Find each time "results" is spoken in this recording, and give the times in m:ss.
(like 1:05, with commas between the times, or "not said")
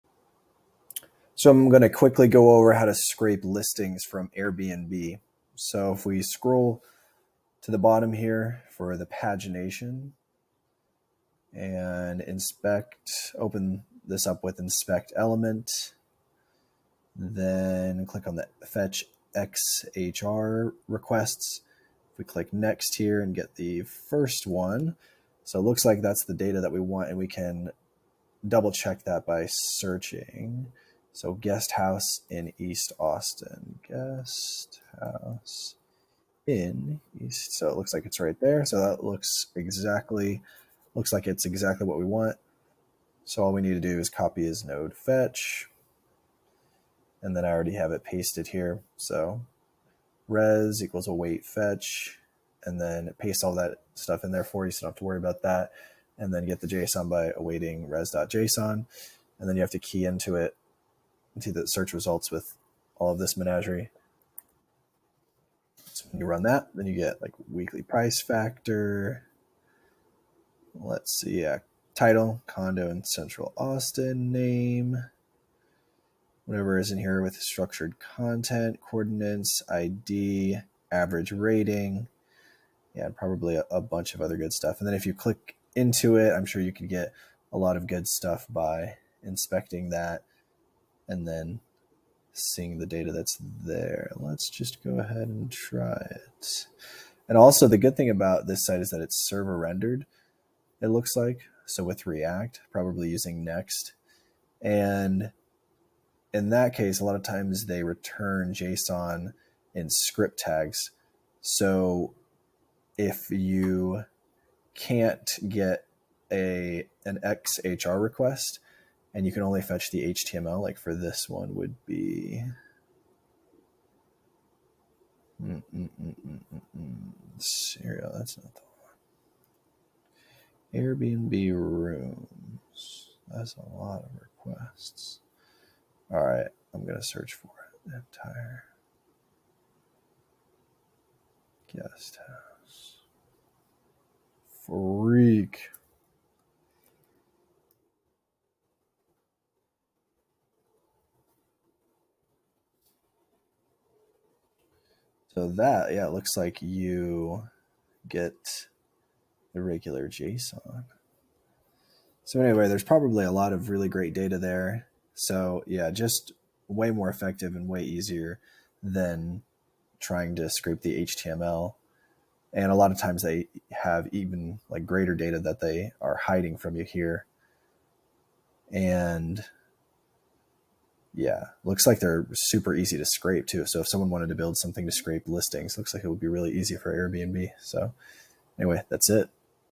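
1:01.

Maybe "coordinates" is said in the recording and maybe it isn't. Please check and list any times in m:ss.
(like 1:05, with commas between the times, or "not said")
1:18.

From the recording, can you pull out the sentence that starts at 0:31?
So guest house in East Austin.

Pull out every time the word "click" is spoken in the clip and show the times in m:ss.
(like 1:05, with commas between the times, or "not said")
0:18, 0:22, 1:25.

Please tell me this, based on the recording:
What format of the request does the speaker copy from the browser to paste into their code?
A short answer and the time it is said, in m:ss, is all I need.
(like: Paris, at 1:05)
node fetch, at 0:44.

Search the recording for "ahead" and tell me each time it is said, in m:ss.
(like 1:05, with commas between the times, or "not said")
1:34.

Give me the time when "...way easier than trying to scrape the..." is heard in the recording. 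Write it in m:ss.
2:47.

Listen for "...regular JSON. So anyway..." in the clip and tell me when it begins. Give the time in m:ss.
2:39.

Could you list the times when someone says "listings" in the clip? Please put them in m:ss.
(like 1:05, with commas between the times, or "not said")
0:03, 3:05.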